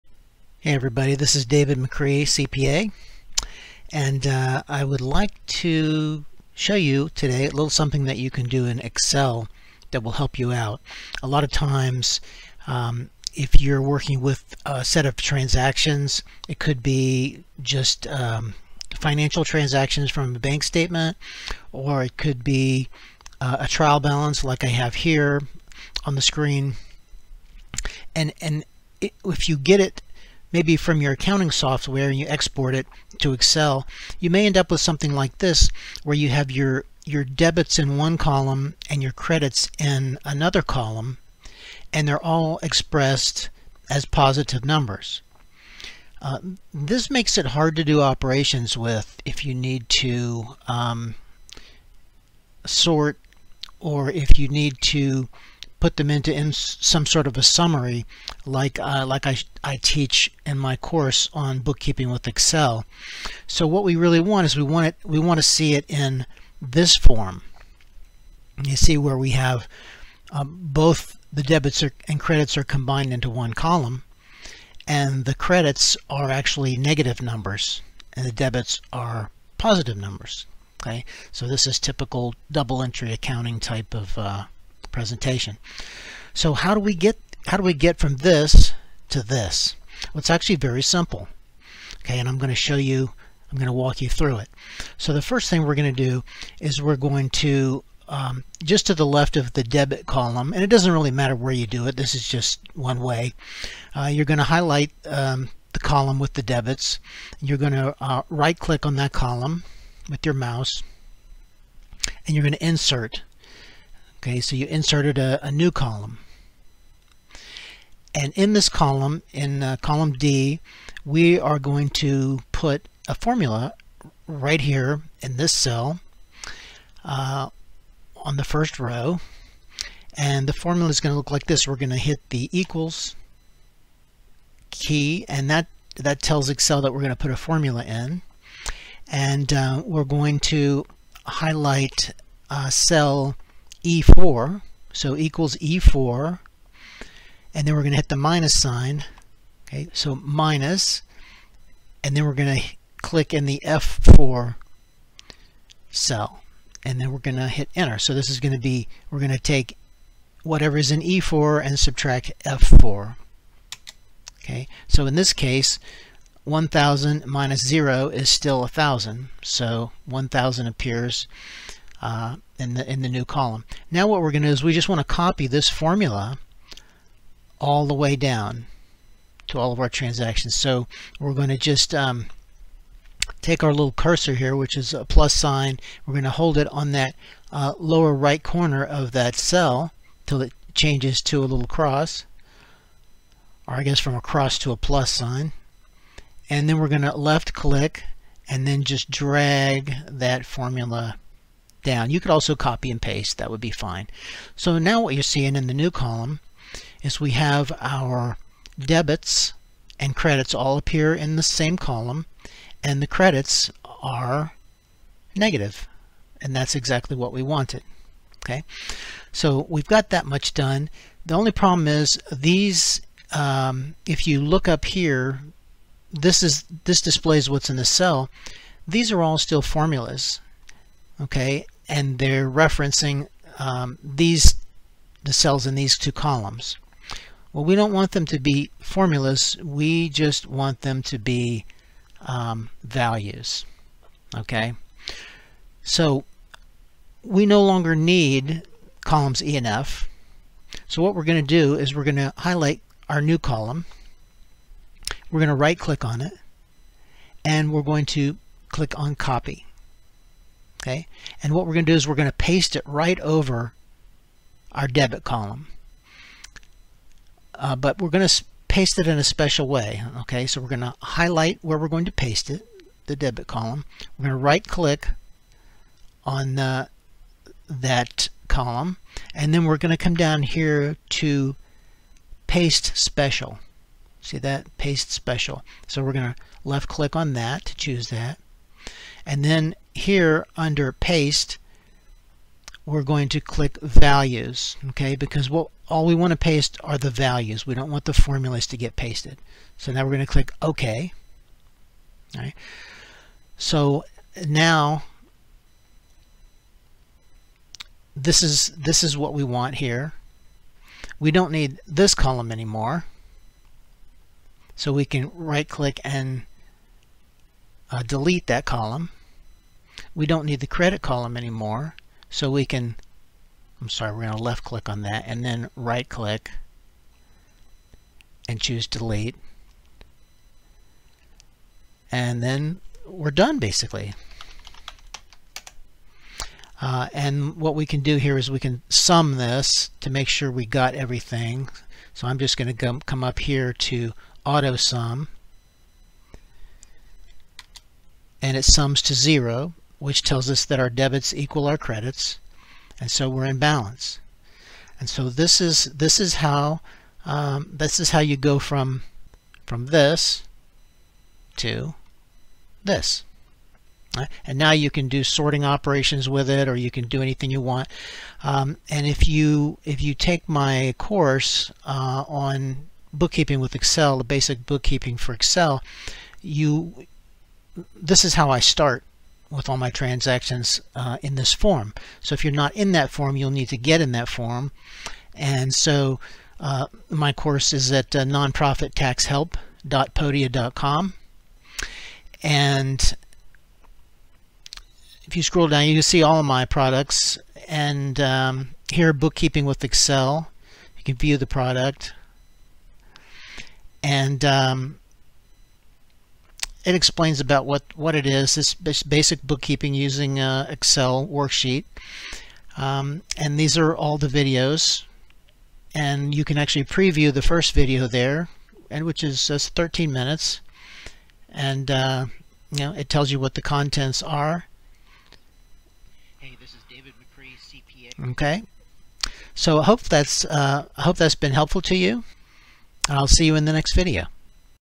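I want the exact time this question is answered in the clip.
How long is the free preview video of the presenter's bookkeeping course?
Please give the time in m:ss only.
6:59.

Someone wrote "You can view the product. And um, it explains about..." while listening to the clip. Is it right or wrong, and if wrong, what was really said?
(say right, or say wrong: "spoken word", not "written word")
right.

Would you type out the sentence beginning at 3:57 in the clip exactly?
Well, we don't want them to be formulas.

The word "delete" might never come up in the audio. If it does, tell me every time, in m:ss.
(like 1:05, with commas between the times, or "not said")
5:18, 5:28.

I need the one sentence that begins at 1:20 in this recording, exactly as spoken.
Okay, so this is typical double entry accounting type of uh, presentation.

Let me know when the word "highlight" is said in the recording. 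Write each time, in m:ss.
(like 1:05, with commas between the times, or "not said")
1:44, 2:21, 4:12, 4:31.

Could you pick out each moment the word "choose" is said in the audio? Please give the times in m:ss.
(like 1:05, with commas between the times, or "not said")
4:47, 5:28.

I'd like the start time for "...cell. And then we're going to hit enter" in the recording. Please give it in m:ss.
2:35.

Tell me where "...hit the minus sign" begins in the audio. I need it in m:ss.
2:27.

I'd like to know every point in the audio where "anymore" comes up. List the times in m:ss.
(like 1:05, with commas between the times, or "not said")
5:12, 5:21.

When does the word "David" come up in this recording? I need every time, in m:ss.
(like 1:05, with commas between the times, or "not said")
0:01, 7:06.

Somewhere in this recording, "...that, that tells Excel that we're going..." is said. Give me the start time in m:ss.
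2:15.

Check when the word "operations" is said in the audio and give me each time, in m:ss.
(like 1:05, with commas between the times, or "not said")
0:48, 6:05.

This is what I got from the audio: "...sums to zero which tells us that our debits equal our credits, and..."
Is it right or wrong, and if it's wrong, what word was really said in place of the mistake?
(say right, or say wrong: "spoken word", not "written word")
right.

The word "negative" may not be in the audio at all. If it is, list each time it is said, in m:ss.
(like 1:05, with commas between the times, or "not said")
1:16, 3:35.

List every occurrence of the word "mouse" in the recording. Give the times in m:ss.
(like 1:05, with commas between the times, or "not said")
1:50.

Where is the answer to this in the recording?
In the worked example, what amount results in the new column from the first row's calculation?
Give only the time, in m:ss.
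2:50.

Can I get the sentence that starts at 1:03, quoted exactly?
So what we really want is we want it we want to see it in this form.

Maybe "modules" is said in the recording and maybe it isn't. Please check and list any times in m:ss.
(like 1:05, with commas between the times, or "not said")
not said.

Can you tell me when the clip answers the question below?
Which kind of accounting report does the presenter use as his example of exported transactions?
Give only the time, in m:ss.
0:23.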